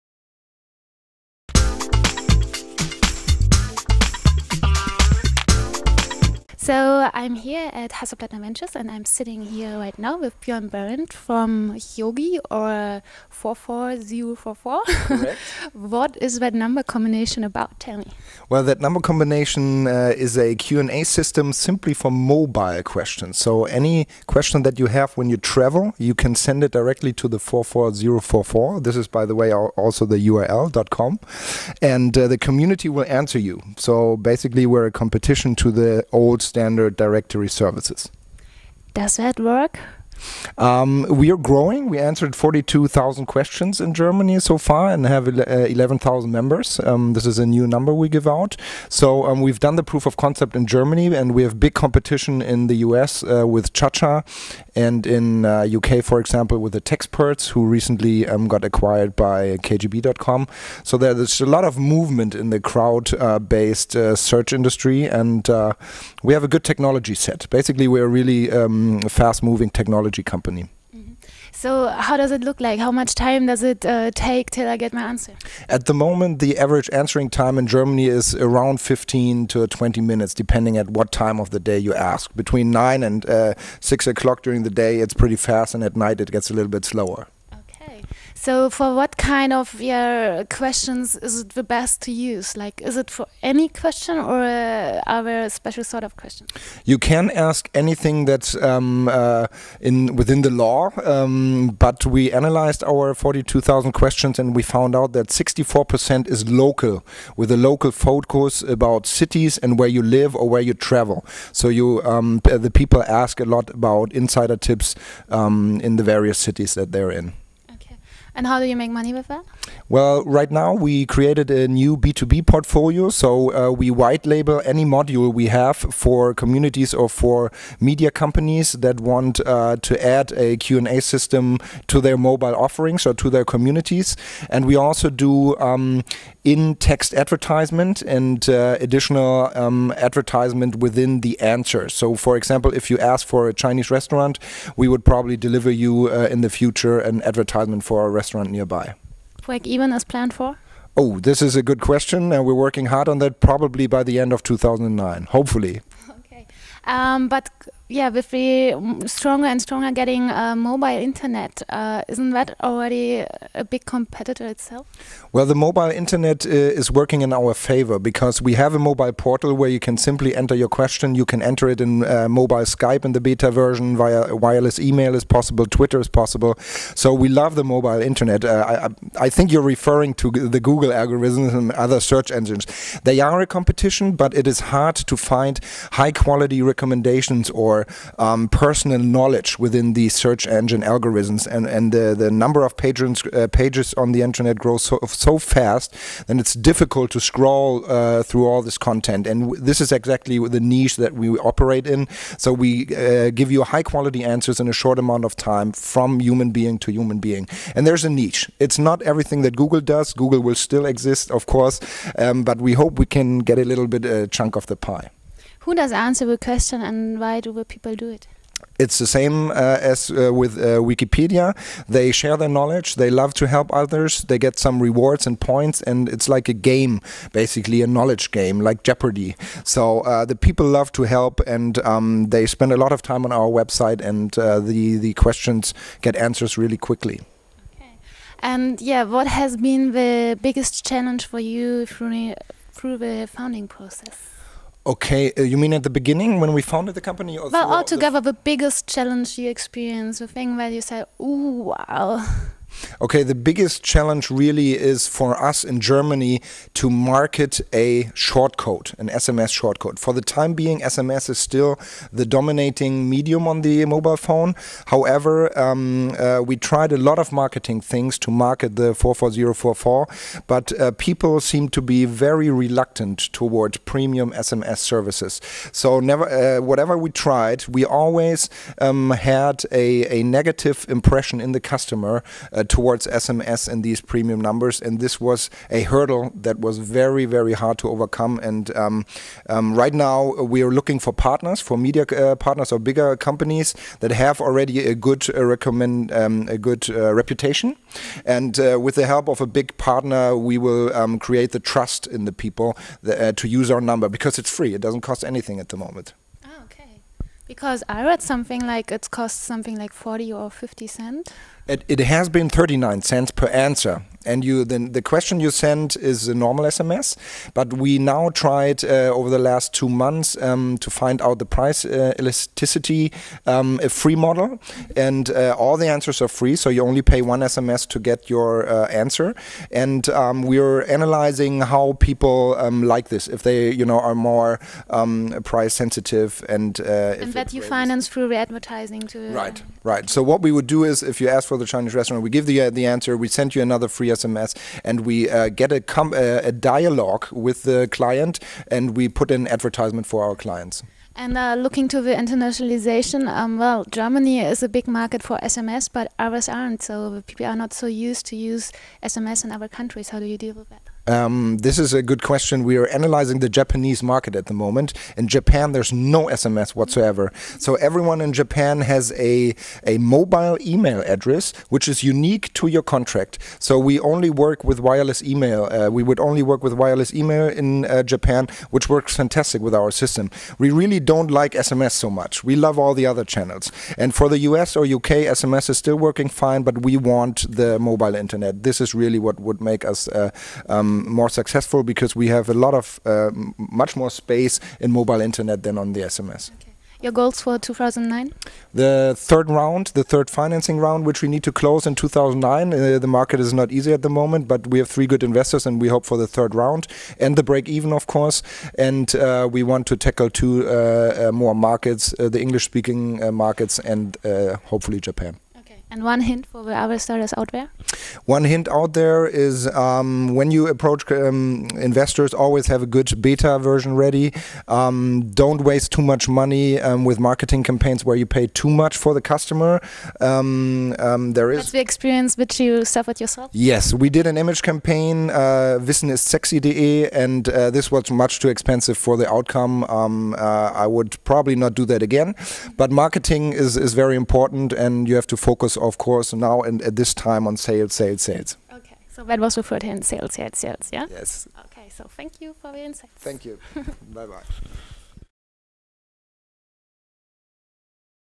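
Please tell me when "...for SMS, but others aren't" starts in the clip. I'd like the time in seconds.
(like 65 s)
355 s.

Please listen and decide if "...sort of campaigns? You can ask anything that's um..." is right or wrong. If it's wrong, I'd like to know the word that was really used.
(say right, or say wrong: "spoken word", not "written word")
wrong: "questions", not "campaigns".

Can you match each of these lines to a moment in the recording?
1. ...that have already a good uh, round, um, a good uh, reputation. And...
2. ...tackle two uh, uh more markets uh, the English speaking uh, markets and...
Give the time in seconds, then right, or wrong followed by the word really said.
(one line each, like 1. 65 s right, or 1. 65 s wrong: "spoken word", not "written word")
1. 293 s wrong: "recommend", not "round"
2. 409 s right.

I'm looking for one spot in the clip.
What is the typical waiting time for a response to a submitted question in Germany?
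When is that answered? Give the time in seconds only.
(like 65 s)
78 s.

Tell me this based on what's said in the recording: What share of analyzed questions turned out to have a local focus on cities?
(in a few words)
64%.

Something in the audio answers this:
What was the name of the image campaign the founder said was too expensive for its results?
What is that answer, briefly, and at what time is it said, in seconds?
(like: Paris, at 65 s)
Wissen ist sexy.de, at 435 s.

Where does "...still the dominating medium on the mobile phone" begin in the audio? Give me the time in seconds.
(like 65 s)
261 s.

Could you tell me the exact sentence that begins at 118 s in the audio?
And how do you make money with that?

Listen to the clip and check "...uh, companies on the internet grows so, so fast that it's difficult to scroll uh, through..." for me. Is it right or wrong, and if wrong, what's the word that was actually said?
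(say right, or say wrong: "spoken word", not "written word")
wrong: "pages", not "companies".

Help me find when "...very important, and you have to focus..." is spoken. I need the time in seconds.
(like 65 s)
443 s.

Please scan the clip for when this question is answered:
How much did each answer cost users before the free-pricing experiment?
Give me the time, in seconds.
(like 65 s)
312 s.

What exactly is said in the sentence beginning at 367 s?
So everyone in Japan has a, a mobile email address, which is unique to your contract.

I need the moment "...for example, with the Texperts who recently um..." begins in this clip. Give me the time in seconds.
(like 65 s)
56 s.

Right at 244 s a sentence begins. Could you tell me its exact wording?
Okay, uh, you mean at the beginning when we founded the company?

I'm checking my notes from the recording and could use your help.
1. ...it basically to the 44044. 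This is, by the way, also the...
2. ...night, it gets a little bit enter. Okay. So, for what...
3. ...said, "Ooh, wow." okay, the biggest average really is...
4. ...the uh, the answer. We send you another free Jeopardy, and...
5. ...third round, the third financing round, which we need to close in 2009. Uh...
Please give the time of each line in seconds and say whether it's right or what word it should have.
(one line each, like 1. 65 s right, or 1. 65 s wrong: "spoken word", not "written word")
1. 26 s wrong: "directly", not "basically"
2. 85 s wrong: "slower", not "enter"
3. 250 s wrong: "challenge", not "average"
4. 342 s wrong: "SMS", not "Jeopardy"
5. 399 s right.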